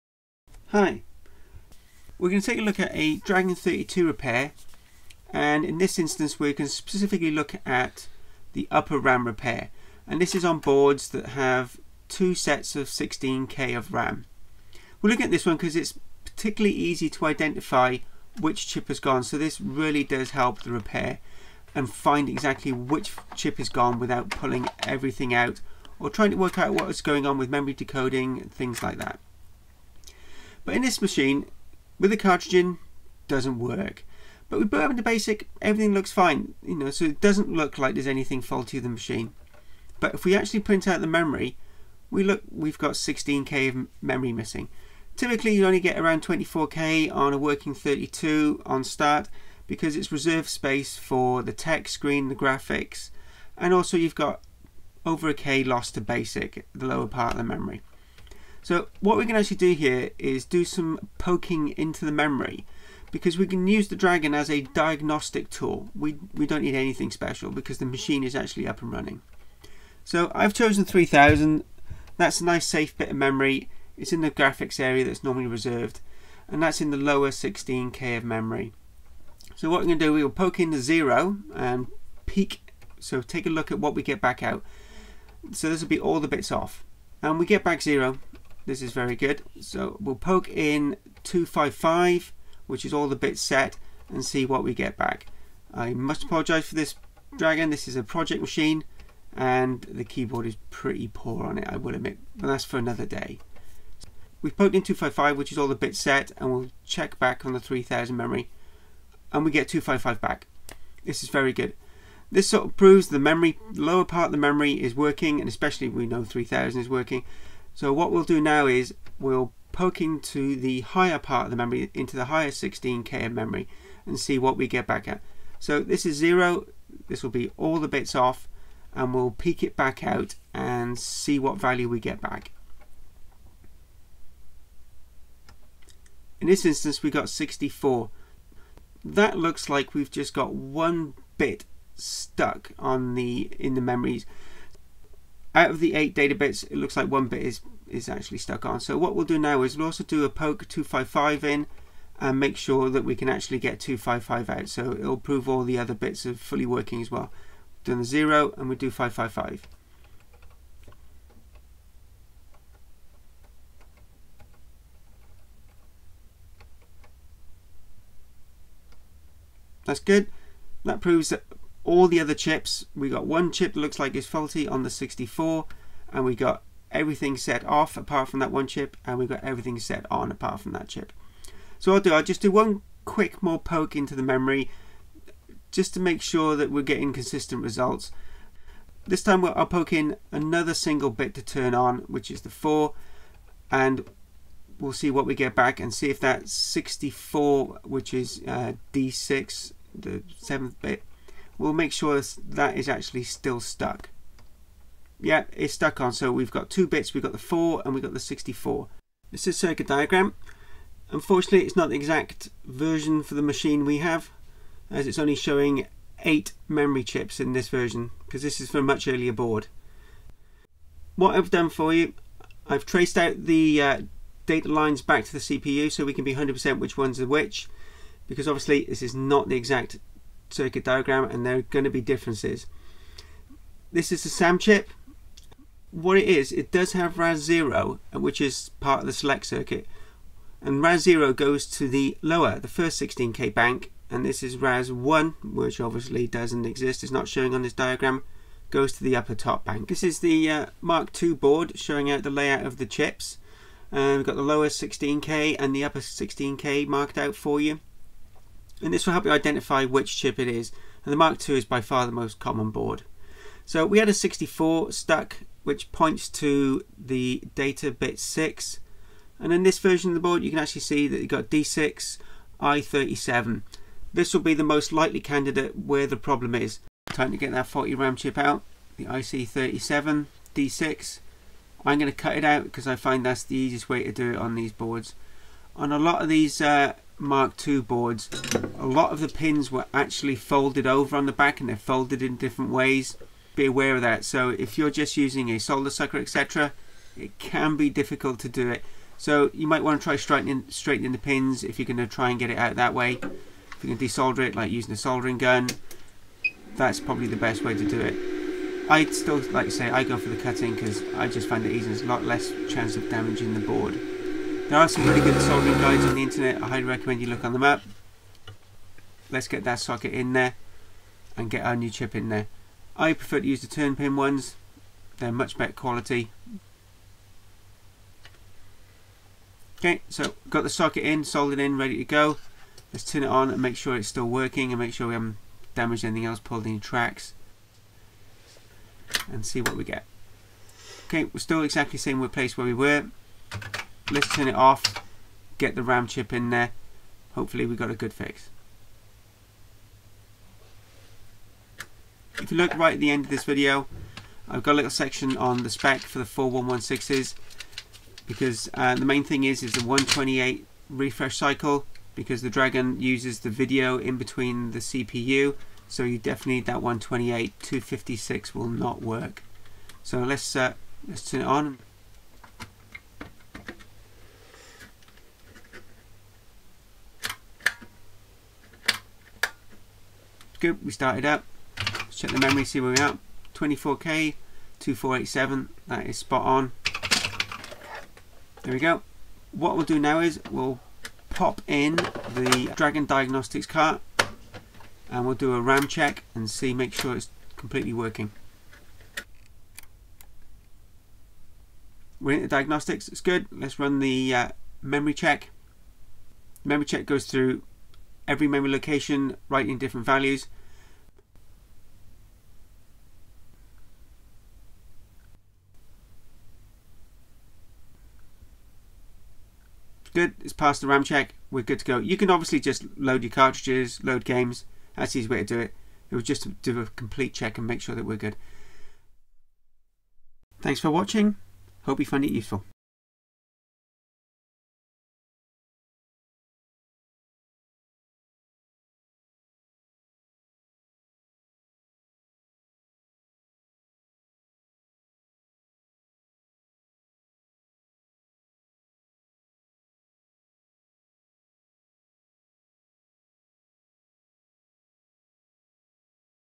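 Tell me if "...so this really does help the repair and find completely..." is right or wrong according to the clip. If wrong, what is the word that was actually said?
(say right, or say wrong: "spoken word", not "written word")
wrong: "exactly", not "completely".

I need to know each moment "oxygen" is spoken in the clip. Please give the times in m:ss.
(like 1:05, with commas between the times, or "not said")
not said.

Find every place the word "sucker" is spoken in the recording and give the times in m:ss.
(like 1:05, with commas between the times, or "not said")
4:55.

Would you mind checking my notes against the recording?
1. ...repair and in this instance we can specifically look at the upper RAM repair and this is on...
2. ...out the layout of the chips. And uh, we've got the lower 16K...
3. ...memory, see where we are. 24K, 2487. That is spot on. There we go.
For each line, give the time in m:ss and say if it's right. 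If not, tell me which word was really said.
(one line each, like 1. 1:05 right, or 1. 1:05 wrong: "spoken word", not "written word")
1. 0:04 right
2. 4:12 right
3. 6:22 right.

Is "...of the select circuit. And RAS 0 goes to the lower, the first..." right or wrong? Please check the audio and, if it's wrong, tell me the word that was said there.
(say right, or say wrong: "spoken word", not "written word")
right.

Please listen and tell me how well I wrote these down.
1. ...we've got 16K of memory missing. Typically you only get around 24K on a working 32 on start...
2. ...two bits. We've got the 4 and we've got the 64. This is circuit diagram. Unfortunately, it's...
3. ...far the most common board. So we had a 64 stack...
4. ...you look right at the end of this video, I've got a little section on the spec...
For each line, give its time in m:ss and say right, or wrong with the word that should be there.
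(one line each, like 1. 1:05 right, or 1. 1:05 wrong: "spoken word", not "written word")
1. 0:42 right
2. 3:26 right
3. 4:21 right
4. 5:52 right.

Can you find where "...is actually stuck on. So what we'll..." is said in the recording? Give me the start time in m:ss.
2:27.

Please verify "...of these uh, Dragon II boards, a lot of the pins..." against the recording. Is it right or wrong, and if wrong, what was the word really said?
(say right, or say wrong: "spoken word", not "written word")
wrong: "Mark", not "Dragon".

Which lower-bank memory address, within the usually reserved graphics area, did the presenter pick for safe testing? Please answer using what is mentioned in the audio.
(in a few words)
3000.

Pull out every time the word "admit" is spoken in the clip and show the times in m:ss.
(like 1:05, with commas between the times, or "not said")
1:41.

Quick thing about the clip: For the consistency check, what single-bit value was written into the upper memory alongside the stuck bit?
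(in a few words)
4.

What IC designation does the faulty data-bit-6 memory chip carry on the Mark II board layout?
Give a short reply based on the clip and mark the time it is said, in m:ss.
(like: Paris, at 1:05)
IC37, at 4:38.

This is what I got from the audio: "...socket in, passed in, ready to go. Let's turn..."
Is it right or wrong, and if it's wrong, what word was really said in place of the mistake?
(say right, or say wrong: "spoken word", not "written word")
wrong: "soldered", not "passed".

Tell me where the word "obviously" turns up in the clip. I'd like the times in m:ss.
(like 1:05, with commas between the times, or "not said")
3:48, 4:05, 7:02.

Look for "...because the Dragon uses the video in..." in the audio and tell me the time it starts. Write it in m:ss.
6:02.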